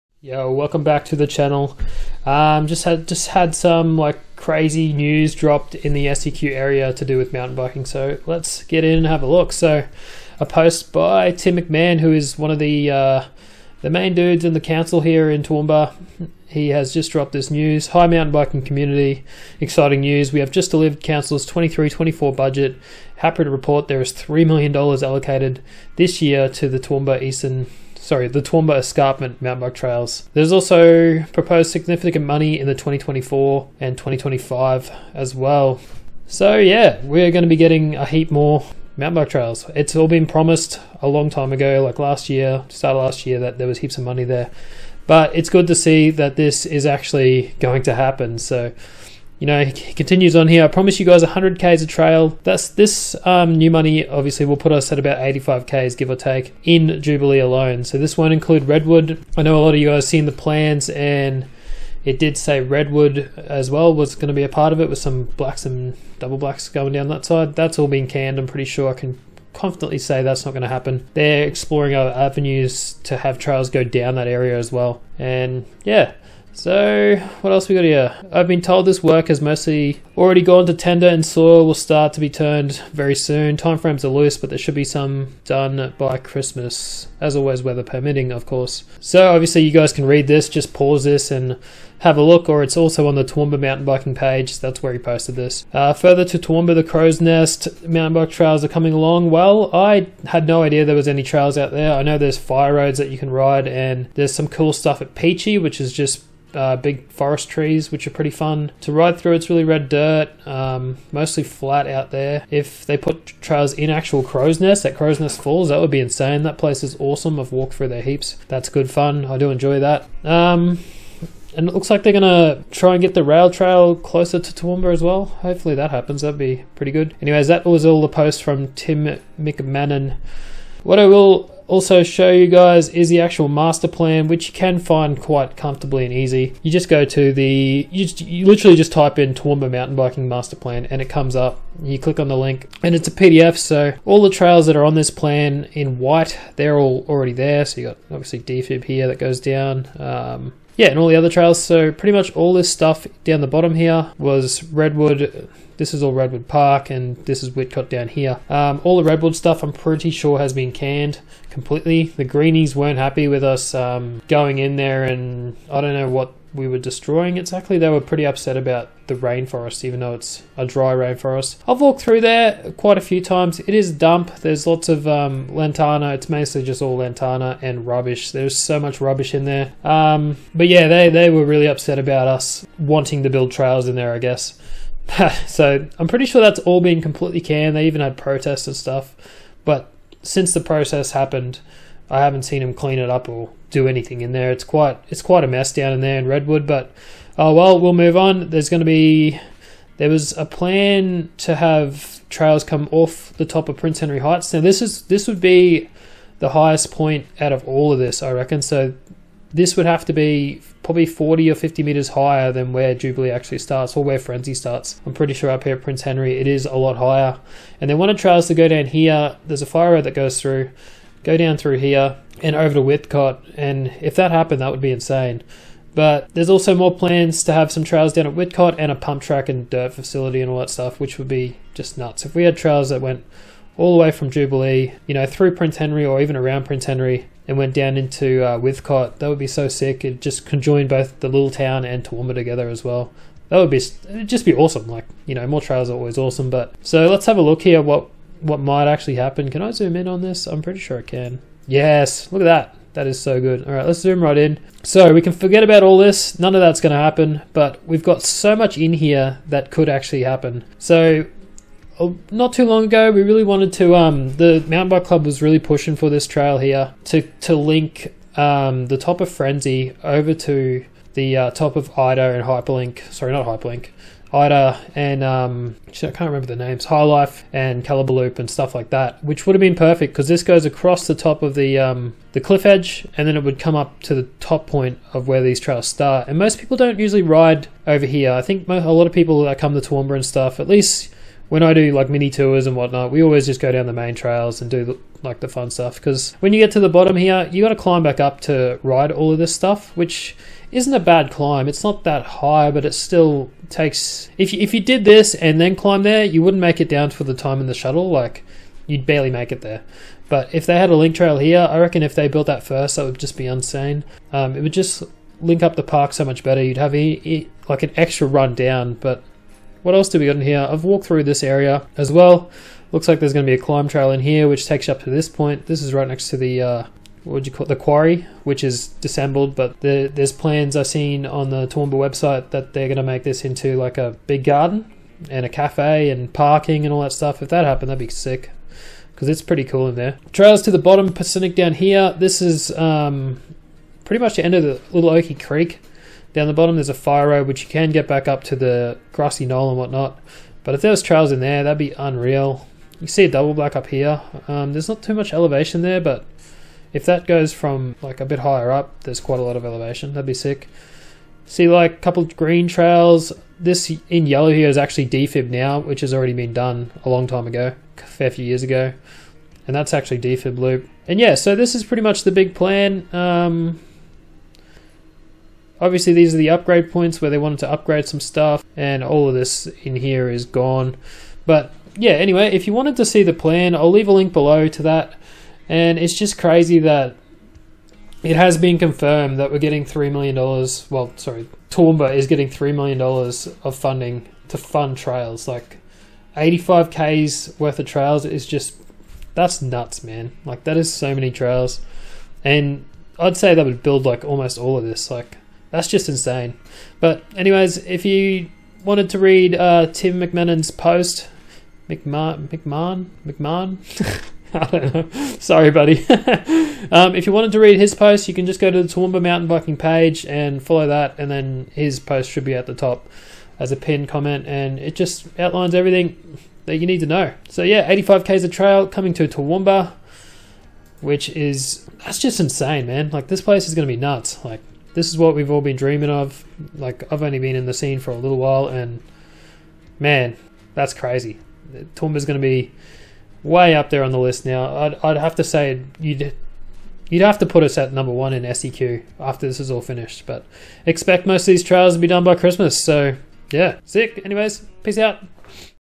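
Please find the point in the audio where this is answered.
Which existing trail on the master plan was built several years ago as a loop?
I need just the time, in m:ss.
6:10.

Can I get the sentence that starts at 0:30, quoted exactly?
There's also proposed significant money in the 2024 and 2025 as well.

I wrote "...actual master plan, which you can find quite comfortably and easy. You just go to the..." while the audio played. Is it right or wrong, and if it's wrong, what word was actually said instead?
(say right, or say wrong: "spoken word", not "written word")
right.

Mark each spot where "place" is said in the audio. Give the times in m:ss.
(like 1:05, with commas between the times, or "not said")
1:56, 7:13.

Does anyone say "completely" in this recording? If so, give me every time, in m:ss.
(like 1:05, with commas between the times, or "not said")
2:41, 3:07.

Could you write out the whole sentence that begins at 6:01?
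See like a couple green trails.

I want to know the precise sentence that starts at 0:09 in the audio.
So a post by Tim McMahon, who is one of the uh, the main dudes in the council here in Toowoomba.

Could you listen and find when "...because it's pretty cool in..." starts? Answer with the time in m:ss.
5:39.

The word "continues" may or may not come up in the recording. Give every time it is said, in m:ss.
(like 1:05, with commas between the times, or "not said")
0:49.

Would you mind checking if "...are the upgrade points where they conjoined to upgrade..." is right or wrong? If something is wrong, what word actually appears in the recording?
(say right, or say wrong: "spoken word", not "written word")
wrong: "wanted", not "conjoined".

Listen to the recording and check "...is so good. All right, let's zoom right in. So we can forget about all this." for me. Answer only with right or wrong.
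right.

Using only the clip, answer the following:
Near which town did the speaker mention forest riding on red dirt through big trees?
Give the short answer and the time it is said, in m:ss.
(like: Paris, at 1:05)
Pechey, at 1:45.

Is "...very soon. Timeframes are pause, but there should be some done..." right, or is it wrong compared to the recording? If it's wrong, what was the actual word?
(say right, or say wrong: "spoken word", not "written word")
wrong: "loose", not "pause".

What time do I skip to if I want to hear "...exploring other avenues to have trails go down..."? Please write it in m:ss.
1:11.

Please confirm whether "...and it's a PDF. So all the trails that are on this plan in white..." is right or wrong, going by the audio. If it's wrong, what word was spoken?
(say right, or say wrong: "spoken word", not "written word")
right.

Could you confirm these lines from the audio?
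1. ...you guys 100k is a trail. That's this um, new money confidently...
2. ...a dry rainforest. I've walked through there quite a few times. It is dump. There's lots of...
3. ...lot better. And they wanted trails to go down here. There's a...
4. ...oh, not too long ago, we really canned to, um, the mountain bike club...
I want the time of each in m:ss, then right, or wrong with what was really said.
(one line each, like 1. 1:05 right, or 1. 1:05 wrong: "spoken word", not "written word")
1. 0:50 wrong: "obviously", not "confidently"
2. 2:50 right
3. 3:36 wrong: "higher", not "better"
4. 4:21 wrong: "wanted", not "canned".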